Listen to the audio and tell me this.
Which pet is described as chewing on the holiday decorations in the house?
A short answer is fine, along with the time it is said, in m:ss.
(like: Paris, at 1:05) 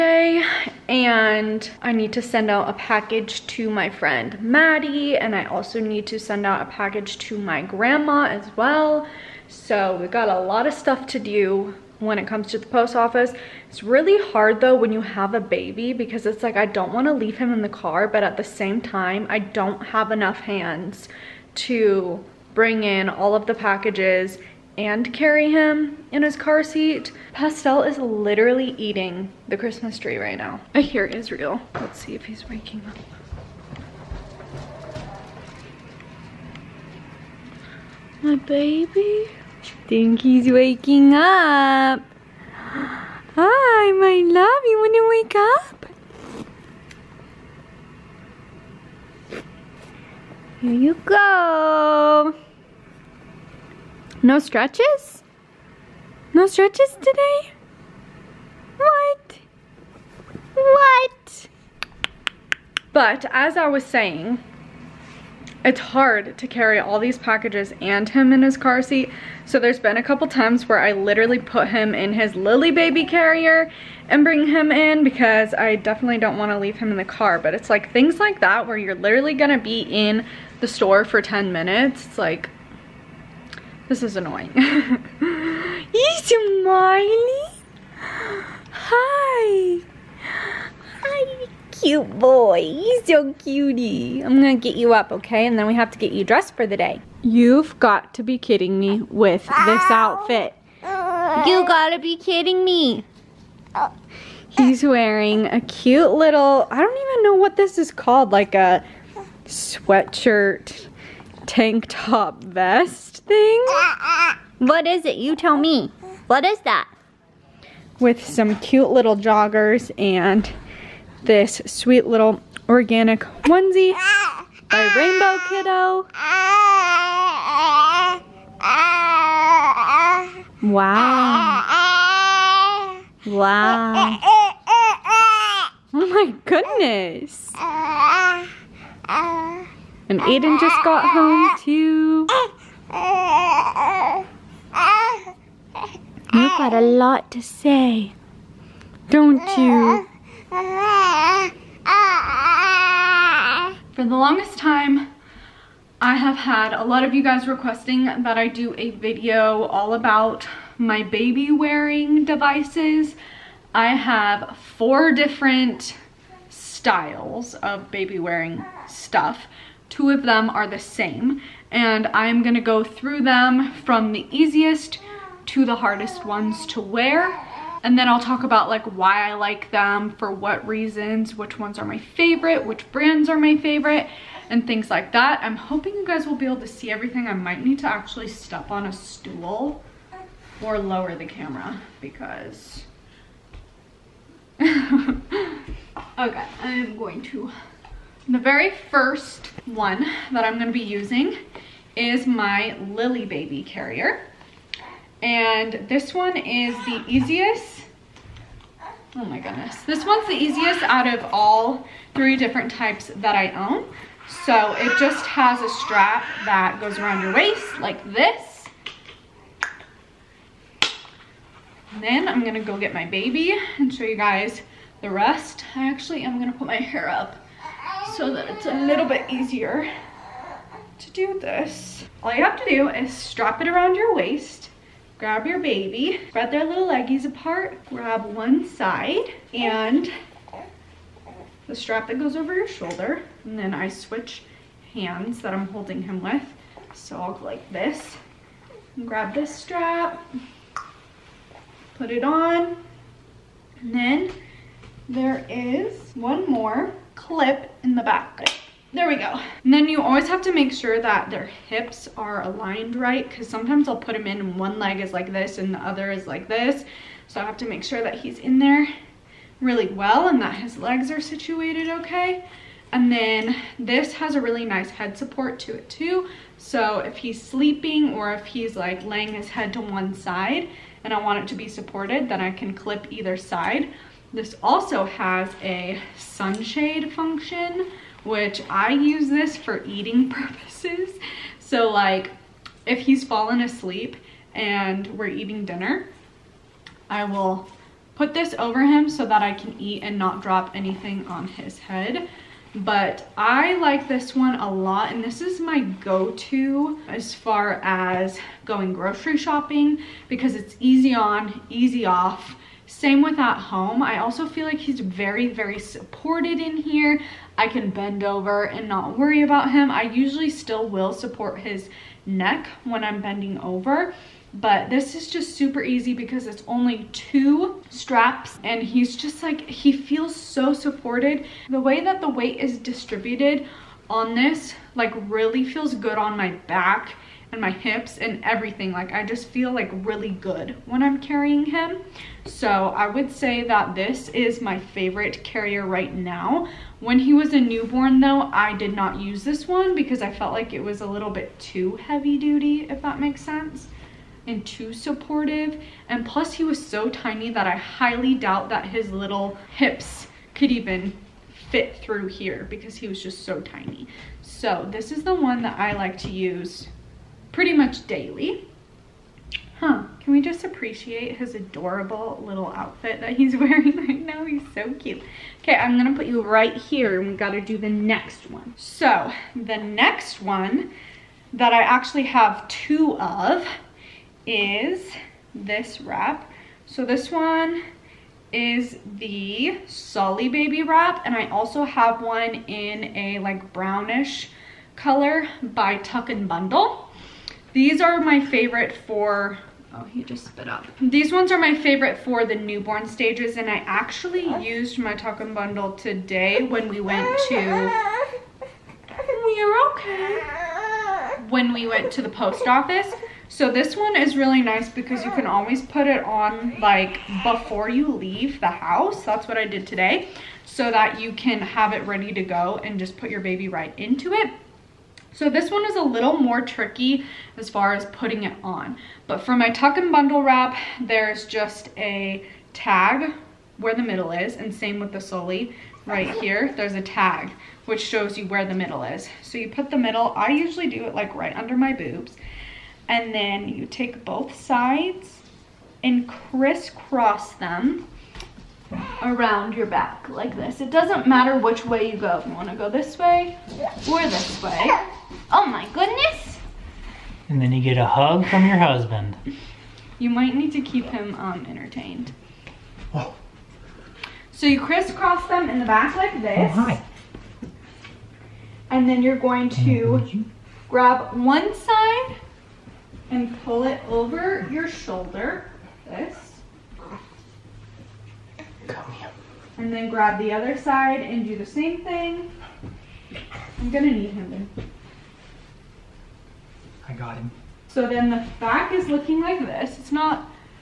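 Pastel, at 0:27.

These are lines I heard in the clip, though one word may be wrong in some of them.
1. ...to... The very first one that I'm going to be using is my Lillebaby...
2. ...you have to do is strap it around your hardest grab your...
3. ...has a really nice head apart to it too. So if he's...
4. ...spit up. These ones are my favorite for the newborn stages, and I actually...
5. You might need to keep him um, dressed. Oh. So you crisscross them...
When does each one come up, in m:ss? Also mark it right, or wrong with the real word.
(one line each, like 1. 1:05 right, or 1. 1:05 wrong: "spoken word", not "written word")
1. 3:17 right
2. 3:52 wrong: "waist", not "hardest"
3. 4:34 wrong: "support", not "apart"
4. 6:40 right
5. 7:40 wrong: "entertained", not "dressed".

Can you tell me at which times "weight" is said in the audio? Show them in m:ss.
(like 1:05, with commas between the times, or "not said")
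5:32.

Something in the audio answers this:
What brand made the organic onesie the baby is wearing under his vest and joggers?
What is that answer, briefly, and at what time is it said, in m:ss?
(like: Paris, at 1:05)
Rainbow Kiddo, at 2:04.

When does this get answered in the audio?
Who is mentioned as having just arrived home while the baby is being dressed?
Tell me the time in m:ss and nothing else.
2:20.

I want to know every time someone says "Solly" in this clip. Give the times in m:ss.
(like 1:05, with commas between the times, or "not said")
6:29, 7:15.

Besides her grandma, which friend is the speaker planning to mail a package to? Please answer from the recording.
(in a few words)
Maddie.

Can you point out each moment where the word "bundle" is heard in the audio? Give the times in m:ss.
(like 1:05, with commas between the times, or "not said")
6:36, 6:45, 7:10.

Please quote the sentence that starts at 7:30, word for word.
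It doesn't matter which way you go.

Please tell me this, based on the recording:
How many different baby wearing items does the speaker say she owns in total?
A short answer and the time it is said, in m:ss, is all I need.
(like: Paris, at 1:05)
4, at 2:44.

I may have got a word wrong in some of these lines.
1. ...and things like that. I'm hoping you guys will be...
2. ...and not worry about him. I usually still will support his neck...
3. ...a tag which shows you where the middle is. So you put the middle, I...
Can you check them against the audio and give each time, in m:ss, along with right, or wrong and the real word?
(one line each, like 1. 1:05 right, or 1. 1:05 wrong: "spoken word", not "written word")
1. 3:04 right
2. 5:18 right
3. 7:16 right.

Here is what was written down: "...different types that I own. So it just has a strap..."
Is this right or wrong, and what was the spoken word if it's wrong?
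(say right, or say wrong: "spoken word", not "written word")
right.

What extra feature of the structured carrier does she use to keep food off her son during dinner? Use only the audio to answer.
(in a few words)
sunshade.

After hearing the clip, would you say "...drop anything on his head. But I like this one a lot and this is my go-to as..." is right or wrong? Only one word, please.
right.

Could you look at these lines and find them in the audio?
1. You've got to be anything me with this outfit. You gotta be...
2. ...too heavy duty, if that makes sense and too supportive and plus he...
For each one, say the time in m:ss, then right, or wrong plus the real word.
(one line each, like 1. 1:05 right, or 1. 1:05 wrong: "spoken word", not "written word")
1. 1:37 wrong: "kidding", not "anything"
2. 5:51 right.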